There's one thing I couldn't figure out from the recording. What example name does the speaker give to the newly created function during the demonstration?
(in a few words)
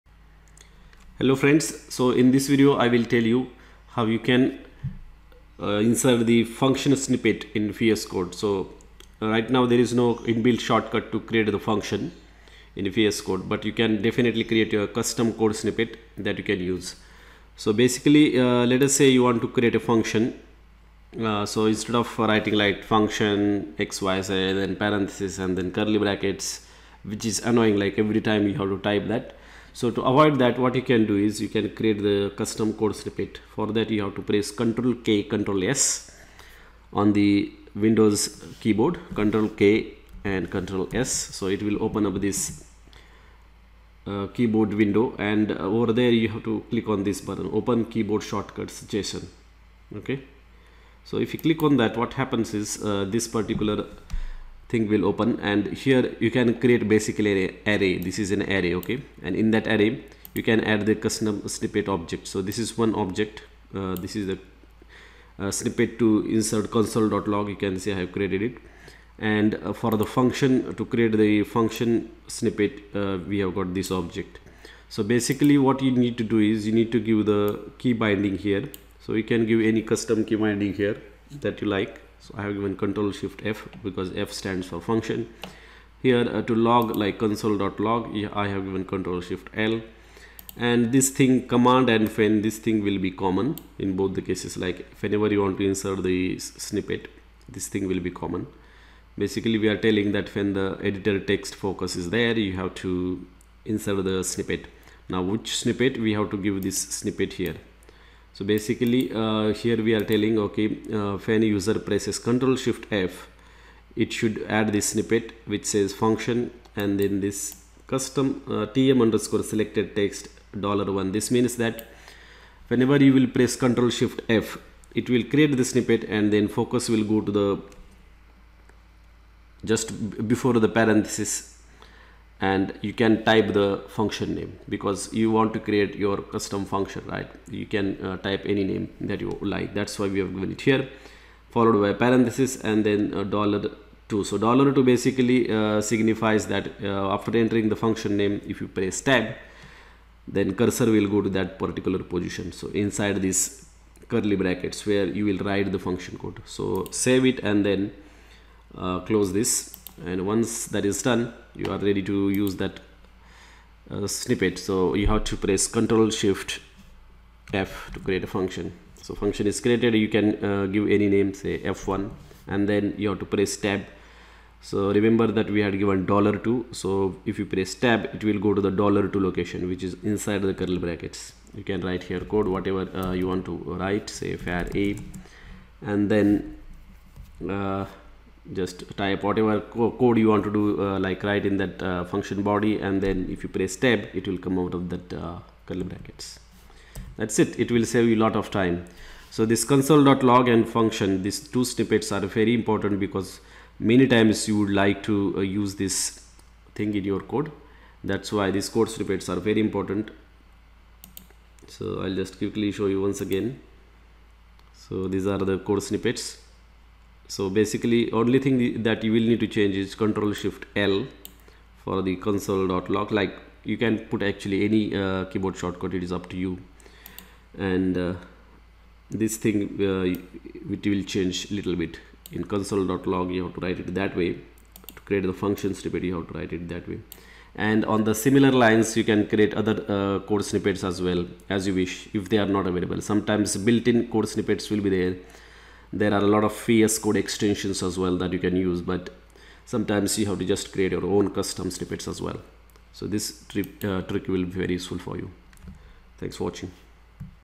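F1.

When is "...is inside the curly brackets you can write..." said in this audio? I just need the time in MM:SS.
02:59.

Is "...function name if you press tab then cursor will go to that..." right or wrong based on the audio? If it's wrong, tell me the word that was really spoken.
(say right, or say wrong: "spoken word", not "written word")
right.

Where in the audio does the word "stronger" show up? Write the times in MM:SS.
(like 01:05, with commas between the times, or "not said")
not said.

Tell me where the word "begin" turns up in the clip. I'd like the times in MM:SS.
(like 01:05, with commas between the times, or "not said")
not said.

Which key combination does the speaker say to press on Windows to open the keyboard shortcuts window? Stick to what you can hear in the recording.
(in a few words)
Control K, Control S.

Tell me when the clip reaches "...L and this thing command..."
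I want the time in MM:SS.
01:29.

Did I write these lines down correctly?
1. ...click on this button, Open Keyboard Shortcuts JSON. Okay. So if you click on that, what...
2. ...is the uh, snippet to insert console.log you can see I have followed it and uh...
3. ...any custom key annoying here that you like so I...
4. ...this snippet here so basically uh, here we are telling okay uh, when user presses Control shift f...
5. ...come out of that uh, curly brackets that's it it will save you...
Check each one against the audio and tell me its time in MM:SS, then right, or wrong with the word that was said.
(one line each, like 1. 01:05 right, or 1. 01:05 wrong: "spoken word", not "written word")
1. 00:46 right
2. 01:04 wrong: "created", not "followed"
3. 01:19 wrong: "binding", not "annoying"
4. 01:46 right
5. 03:14 right.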